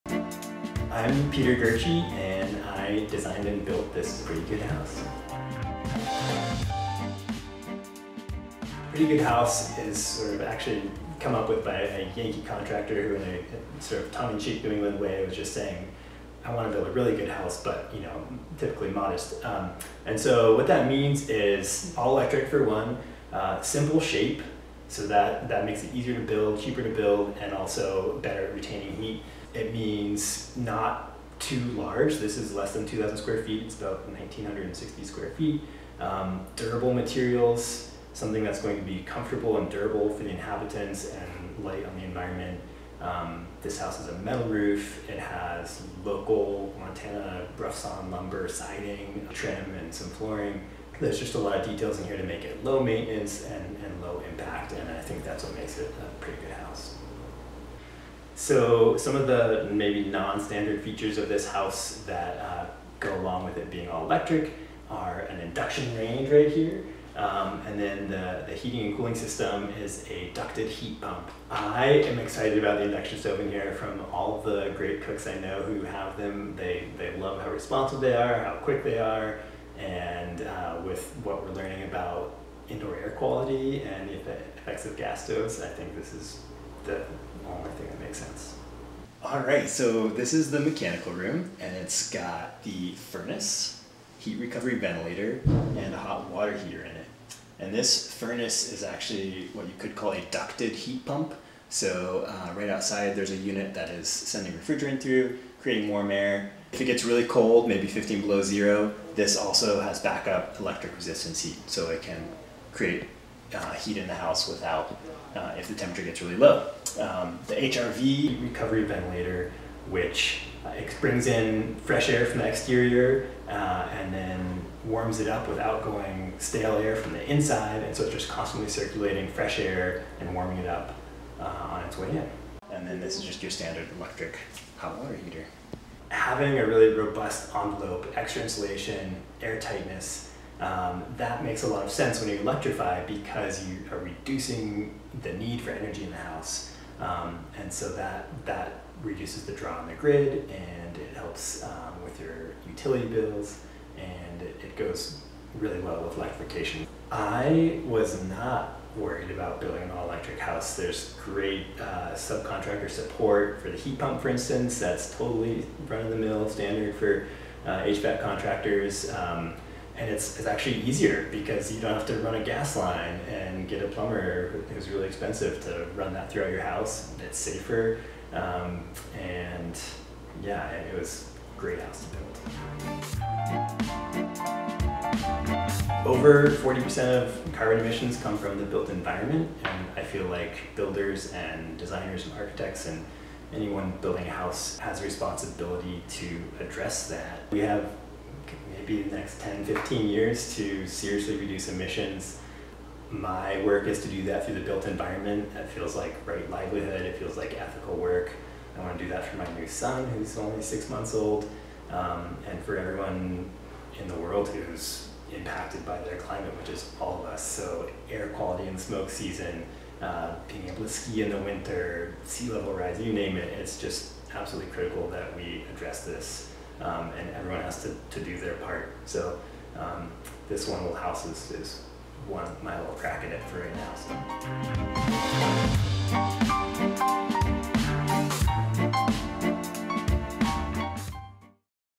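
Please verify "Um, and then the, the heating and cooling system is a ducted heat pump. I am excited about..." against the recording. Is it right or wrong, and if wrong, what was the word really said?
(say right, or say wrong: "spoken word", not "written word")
right.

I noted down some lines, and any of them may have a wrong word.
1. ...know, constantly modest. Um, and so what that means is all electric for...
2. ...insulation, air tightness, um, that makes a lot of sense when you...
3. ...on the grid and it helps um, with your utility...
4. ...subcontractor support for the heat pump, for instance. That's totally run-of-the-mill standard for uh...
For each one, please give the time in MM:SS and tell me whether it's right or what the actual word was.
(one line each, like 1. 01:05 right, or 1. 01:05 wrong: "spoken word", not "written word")
1. 00:18 wrong: "typically", not "constantly"
2. 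02:18 right
3. 02:29 right
4. 02:42 right.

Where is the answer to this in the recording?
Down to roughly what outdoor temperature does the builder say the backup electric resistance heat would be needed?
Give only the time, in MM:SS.
01:47.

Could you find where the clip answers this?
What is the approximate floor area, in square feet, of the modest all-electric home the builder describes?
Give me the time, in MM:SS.
00:34.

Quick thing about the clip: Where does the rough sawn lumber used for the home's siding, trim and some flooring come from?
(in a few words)
Montana.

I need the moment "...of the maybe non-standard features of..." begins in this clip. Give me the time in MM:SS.
00:59.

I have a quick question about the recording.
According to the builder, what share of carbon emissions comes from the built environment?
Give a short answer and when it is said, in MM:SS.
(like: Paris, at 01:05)
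Over 40%, at 03:06.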